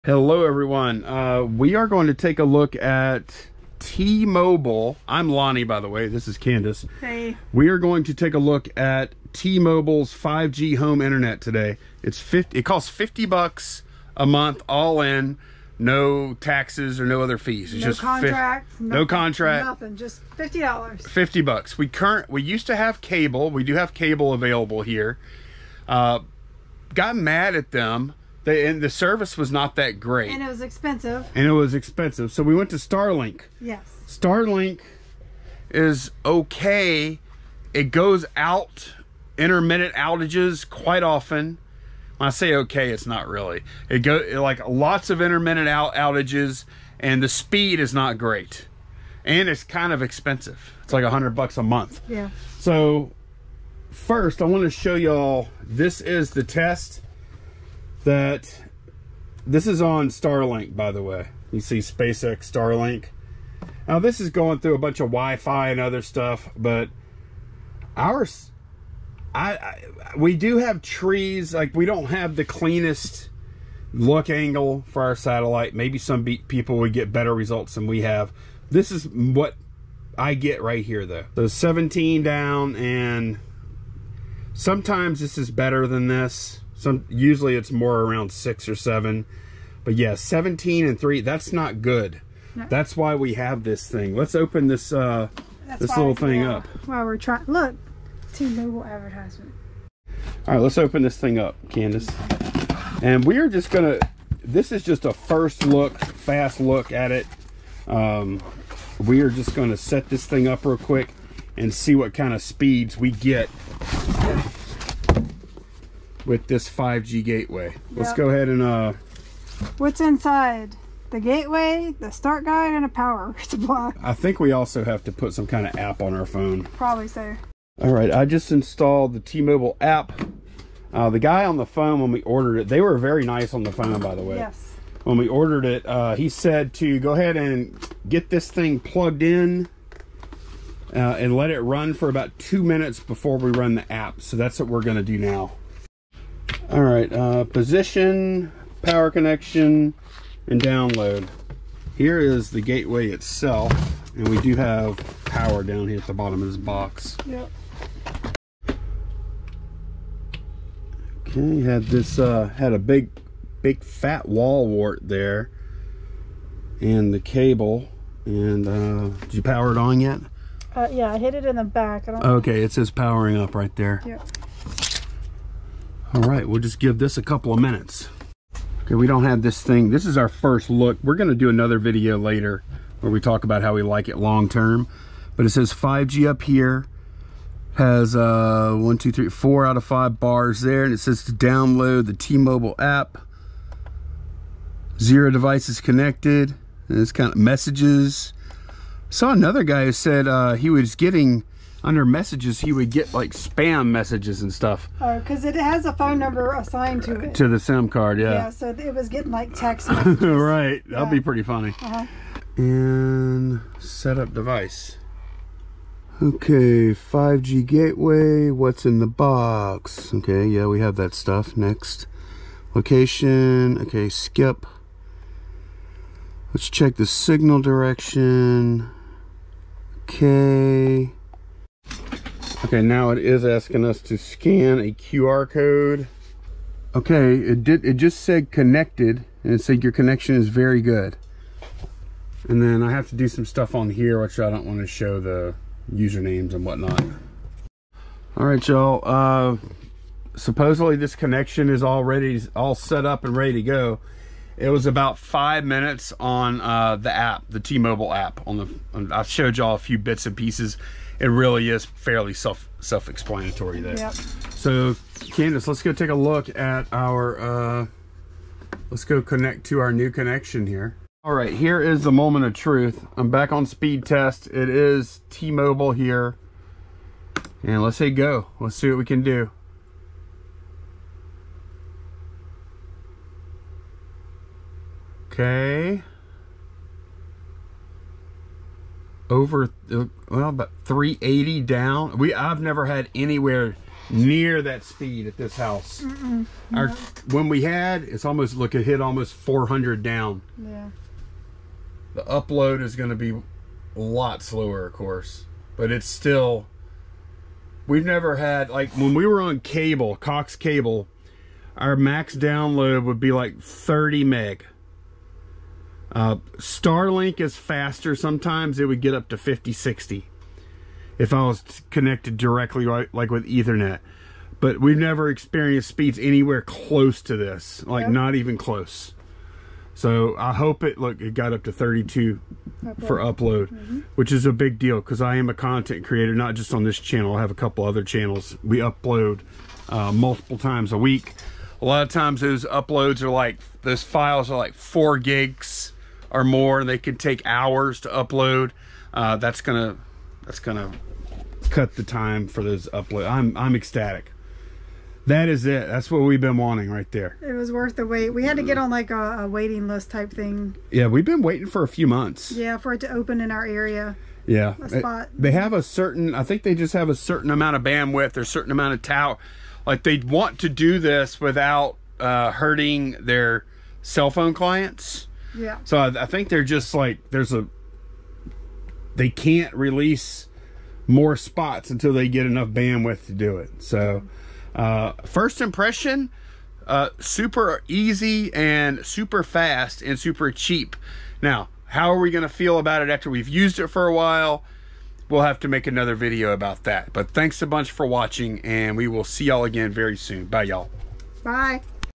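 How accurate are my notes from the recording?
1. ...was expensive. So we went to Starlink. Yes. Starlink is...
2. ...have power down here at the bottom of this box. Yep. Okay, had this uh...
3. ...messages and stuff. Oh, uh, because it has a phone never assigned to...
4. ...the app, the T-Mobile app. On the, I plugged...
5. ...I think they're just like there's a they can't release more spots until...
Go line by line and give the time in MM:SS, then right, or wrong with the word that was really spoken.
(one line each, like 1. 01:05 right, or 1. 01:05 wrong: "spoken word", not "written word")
1. 00:31 right
2. 02:34 right
3. 03:23 wrong: "number", not "never"
4. 04:16 wrong: "showed", not "plugged"
5. 06:16 right.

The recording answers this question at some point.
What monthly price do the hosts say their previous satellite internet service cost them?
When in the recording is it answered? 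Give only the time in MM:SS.
00:51.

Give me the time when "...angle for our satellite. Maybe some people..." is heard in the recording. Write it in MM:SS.
01:14.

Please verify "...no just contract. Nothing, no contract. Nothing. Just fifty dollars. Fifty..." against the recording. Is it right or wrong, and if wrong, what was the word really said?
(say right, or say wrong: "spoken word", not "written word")
right.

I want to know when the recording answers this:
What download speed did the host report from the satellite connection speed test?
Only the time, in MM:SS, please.
01:21.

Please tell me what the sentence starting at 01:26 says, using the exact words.
Some Usually it's more around six or seven.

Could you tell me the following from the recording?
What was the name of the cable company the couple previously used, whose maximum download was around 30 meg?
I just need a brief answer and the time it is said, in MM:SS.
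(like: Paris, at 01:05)
Cox, at 05:10.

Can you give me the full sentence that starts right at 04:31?
All right, here is the moment of truth.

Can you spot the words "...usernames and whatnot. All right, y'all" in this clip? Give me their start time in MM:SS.
04:05.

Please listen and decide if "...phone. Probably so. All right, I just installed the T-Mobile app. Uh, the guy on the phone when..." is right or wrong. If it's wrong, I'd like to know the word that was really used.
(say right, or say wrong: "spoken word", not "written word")
right.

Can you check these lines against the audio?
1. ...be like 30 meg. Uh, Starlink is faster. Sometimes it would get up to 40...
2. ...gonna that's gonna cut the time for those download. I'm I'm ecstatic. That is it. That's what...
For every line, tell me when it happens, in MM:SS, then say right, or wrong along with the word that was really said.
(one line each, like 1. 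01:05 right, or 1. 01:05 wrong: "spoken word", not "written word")
1. 05:13 wrong: "50", not "40"
2. 05:49 wrong: "upload", not "download".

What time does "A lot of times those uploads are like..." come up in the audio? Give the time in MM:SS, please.
05:41.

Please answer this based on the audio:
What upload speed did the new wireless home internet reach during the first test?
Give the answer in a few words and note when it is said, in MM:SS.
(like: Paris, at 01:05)
32, at 05:31.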